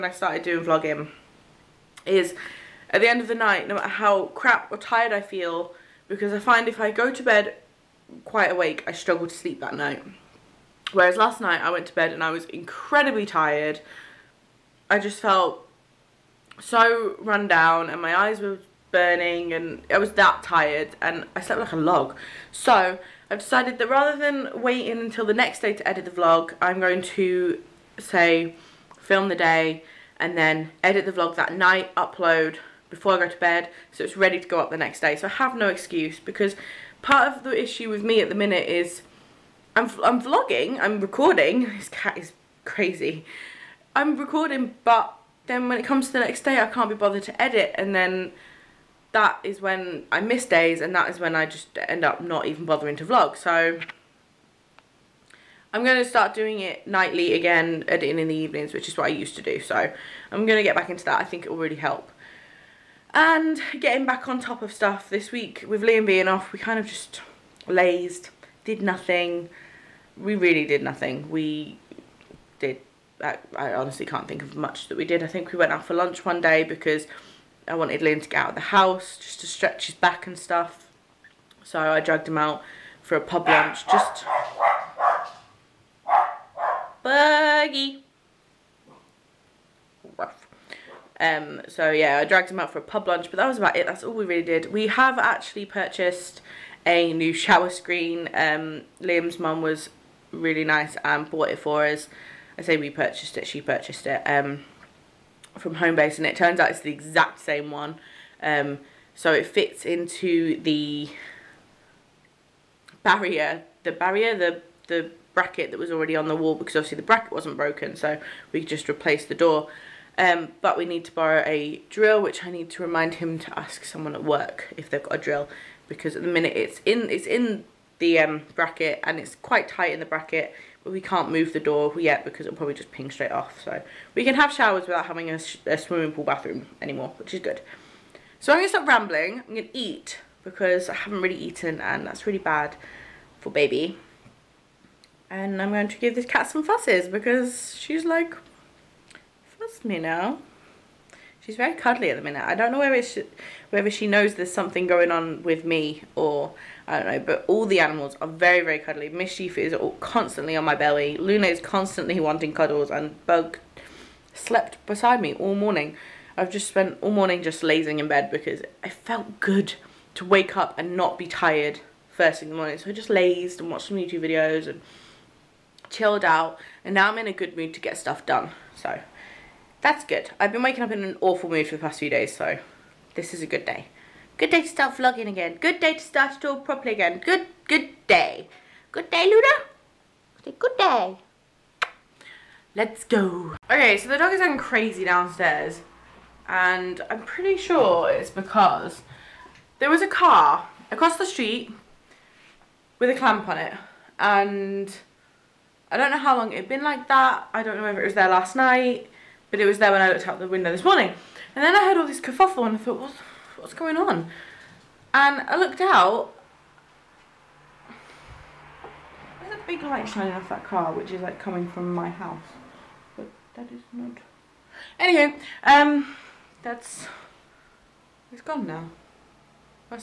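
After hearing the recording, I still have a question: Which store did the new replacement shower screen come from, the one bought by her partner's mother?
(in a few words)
Homebase.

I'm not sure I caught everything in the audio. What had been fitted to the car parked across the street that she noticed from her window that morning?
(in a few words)
A clamp.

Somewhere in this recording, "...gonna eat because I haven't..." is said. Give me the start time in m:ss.
2:19.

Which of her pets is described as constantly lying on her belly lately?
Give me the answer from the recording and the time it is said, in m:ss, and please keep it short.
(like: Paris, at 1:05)
Mischief, at 2:39.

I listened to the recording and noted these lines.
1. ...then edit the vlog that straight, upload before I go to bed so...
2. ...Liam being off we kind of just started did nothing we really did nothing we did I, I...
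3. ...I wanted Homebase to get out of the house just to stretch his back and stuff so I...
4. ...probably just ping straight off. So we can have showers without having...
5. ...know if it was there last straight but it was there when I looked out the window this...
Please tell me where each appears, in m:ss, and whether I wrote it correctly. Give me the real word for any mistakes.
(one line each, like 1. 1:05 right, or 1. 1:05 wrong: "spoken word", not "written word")
1. 0:30 wrong: "night", not "straight"
2. 1:05 wrong: "lazed", not "started"
3. 1:17 wrong: "Liam", not "Homebase"
4. 2:12 right
5. 3:27 wrong: "night", not "straight".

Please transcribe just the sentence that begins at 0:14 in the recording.
I just felt so run down and my eyes were burning and I was that tired and I slept like a log.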